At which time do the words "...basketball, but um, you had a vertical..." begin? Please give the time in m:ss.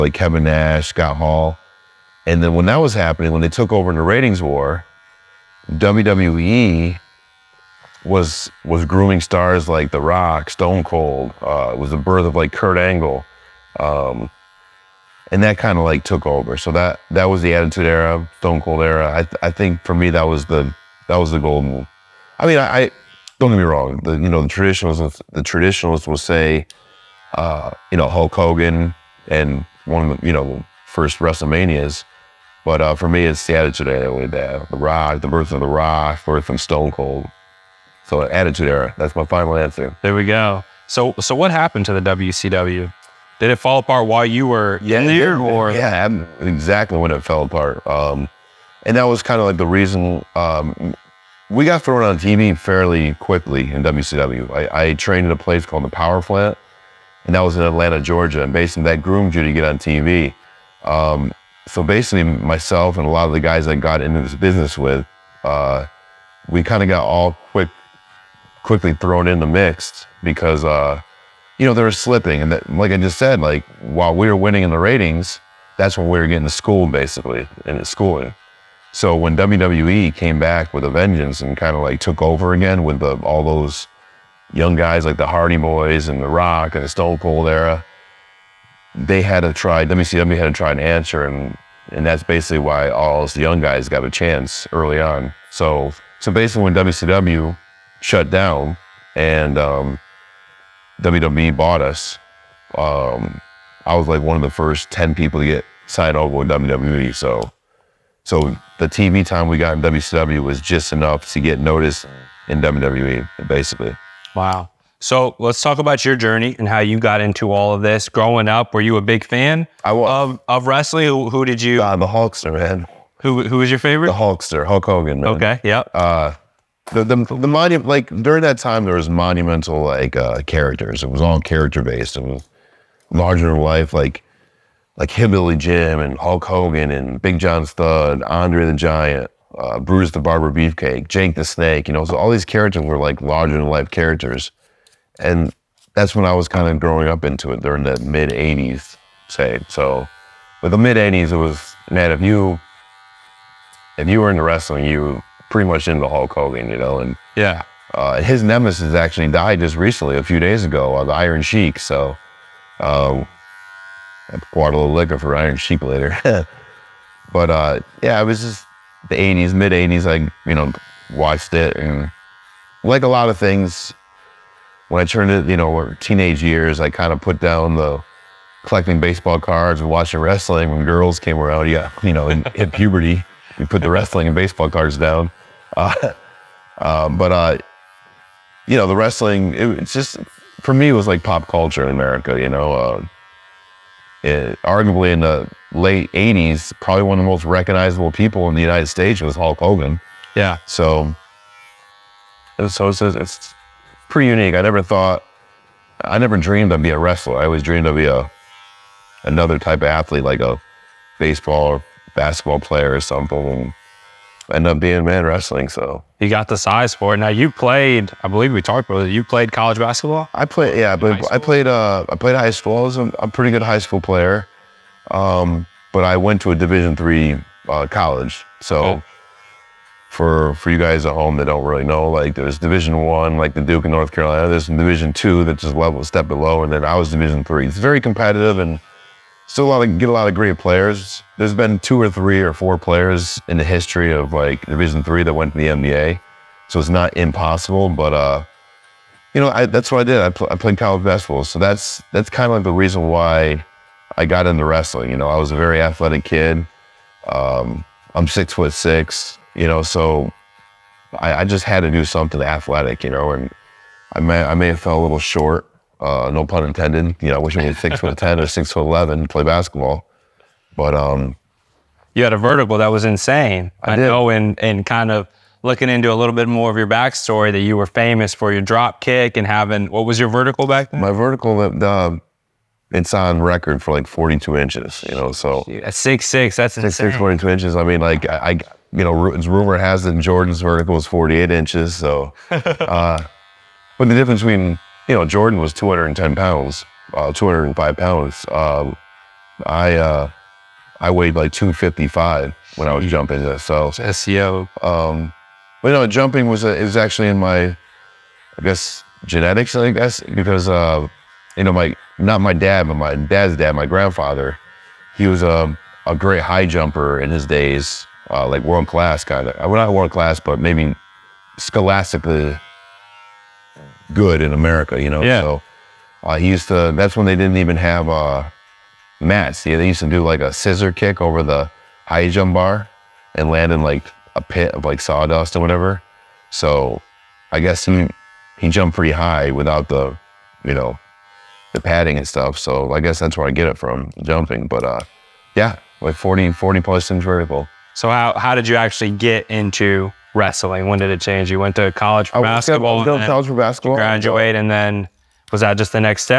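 4:29.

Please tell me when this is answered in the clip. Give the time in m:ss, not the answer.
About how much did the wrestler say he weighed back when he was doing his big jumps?
5:01.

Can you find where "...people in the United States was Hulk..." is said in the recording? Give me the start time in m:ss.
3:18.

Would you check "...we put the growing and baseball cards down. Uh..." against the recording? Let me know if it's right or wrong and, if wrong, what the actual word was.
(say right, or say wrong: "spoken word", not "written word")
wrong: "wrestling", not "growing".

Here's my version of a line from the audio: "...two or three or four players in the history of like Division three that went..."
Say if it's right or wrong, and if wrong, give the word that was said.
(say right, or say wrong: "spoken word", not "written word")
right.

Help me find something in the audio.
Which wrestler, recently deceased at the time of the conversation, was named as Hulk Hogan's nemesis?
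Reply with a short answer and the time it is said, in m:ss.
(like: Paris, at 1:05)
The Iron Sheik, at 2:41.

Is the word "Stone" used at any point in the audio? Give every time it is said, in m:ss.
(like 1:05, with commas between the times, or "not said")
0:10, 0:18, 0:36, 1:26.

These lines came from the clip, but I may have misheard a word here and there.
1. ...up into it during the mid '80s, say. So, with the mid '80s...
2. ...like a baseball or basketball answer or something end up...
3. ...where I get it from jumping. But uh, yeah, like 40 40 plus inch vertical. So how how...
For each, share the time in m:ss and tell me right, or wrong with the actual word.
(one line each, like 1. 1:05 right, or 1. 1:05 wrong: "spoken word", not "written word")
1. 2:27 right
2. 3:30 wrong: "player", not "answer"
3. 5:43 right.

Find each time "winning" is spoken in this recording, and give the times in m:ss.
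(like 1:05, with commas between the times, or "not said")
1:14.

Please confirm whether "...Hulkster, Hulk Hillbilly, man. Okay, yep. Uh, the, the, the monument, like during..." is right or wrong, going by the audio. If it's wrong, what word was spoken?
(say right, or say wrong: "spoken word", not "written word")
wrong: "Hogan", not "Hillbilly".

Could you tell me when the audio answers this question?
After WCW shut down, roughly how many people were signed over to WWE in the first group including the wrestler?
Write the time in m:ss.
1:44.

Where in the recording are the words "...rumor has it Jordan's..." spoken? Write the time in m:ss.
4:49.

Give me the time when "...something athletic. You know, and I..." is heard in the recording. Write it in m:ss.
4:22.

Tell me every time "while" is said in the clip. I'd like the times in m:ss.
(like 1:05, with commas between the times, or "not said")
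0:44, 1:13.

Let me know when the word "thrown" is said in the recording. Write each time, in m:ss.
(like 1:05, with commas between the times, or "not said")
0:51, 1:08.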